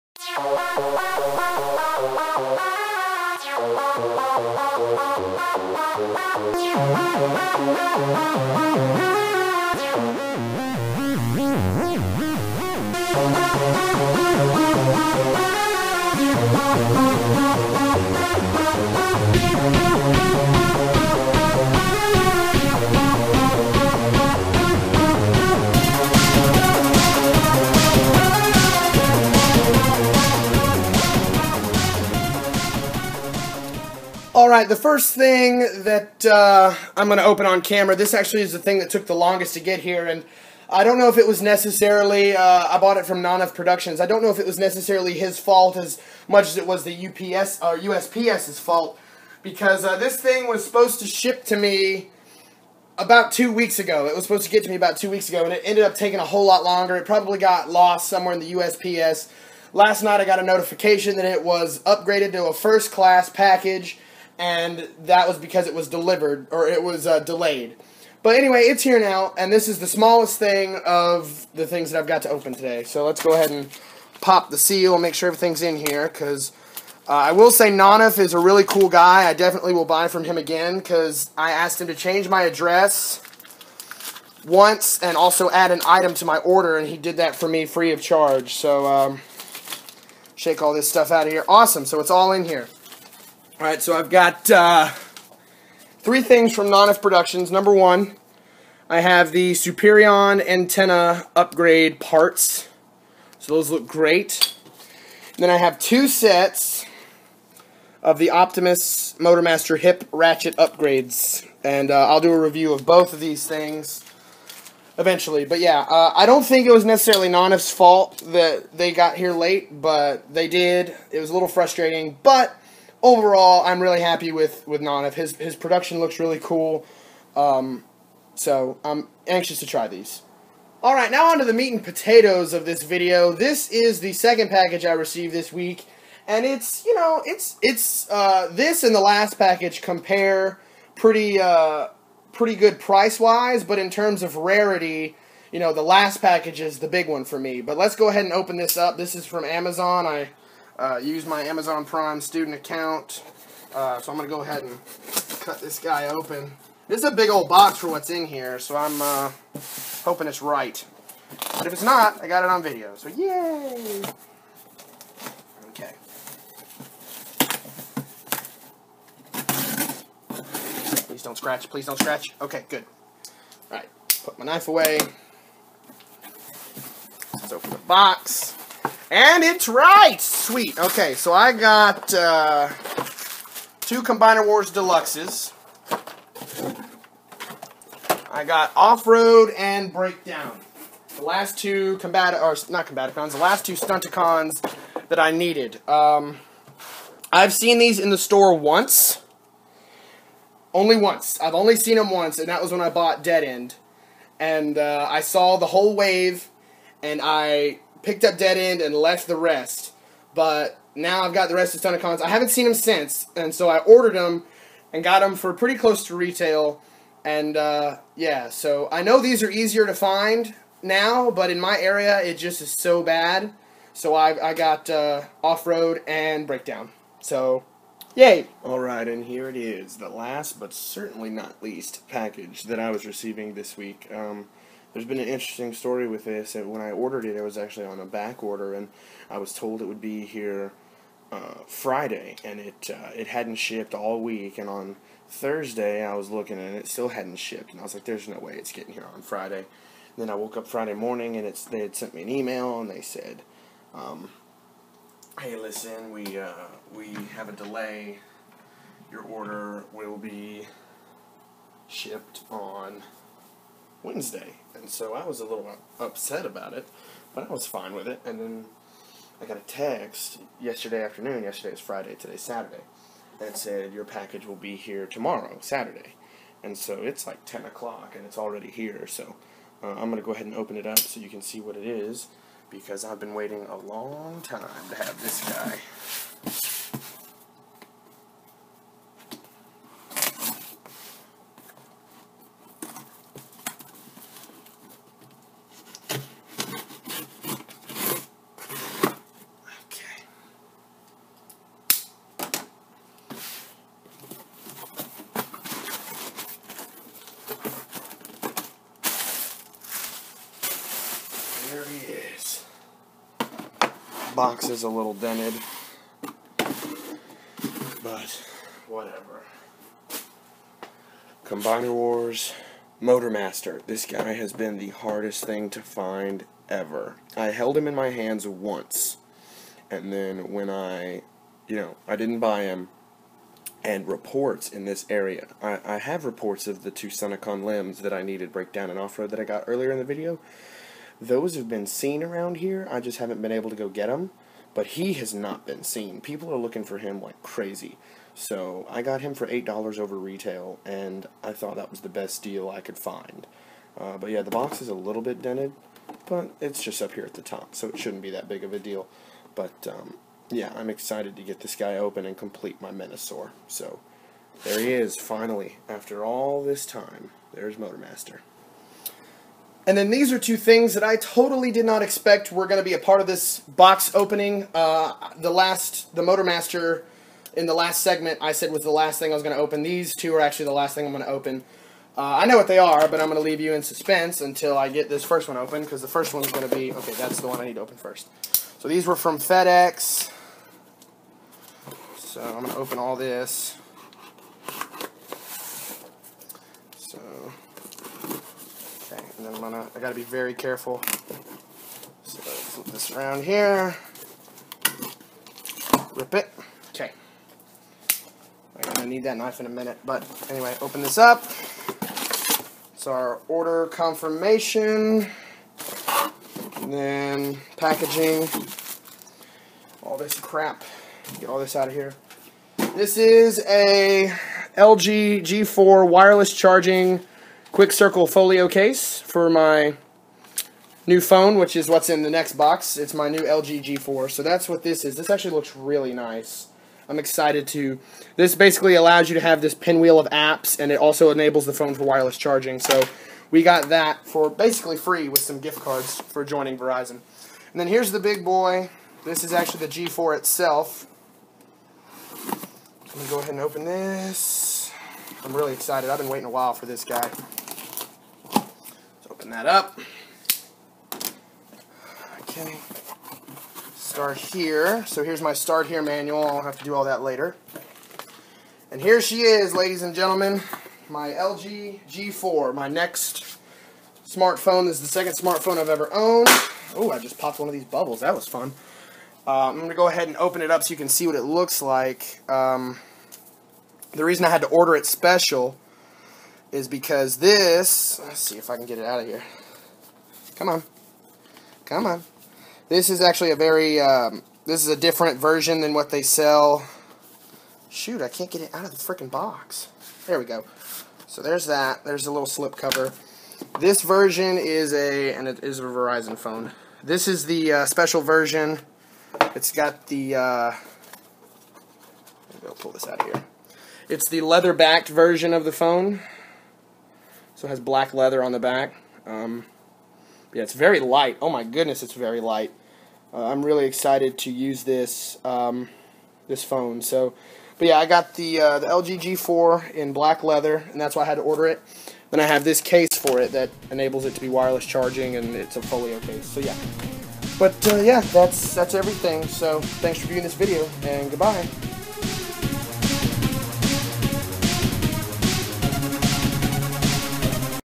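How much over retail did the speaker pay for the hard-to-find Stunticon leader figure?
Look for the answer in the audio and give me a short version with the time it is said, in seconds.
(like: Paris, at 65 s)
$8, at 349 s.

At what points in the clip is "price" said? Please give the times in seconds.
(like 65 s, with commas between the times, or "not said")
142 s.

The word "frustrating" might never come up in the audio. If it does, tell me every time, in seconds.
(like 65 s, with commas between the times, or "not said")
121 s.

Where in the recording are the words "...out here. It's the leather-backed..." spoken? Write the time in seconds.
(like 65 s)
513 s.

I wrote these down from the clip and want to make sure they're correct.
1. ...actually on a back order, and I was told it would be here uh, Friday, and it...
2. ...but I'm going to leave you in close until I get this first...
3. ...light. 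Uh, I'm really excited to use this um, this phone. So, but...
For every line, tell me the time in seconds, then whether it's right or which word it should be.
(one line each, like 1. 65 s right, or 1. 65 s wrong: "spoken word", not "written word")
1. 237 s right
2. 383 s wrong: "suspense", not "close"
3. 522 s right.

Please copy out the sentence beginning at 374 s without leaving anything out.
Uh, the last, the Motormaster in the last segment I said was the last thing I was going to open.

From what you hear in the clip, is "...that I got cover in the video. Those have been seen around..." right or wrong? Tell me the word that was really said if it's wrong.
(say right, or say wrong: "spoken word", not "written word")
wrong: "earlier", not "cover".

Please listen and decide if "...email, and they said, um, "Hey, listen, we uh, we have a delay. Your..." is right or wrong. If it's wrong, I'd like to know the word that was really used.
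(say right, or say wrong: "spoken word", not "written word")
right.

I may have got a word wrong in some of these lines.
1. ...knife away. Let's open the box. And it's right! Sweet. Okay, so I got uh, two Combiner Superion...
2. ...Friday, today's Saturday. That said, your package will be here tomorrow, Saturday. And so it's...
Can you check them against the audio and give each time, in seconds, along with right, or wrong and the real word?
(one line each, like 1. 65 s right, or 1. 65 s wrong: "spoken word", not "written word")
1. 174 s wrong: "Wars", not "Superion"
2. 271 s right.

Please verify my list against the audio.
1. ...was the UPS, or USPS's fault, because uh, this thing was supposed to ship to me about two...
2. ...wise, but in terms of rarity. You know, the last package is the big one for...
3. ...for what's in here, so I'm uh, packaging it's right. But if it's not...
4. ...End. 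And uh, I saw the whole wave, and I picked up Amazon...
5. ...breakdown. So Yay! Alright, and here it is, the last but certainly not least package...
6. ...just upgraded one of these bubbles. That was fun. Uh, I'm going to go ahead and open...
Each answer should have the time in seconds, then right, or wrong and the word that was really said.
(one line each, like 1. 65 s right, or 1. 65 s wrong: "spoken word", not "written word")
1. 46 s right
2. 143 s right
3. 157 s wrong: "hoping", not "packaging"
4. 203 s wrong: "Dead", not "Amazon"
5. 226 s right
6. 477 s wrong: "popped", not "upgraded".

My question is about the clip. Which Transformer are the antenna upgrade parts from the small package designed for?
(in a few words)
Superion.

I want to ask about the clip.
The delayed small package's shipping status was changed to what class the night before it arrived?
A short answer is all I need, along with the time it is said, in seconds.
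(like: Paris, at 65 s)
First class, at 62 s.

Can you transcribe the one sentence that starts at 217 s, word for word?
And uh, yeah, so I know these are easier to find now, but in my area it just is so bad.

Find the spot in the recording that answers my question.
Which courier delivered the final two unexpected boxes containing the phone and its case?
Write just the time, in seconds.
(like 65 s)
389 s.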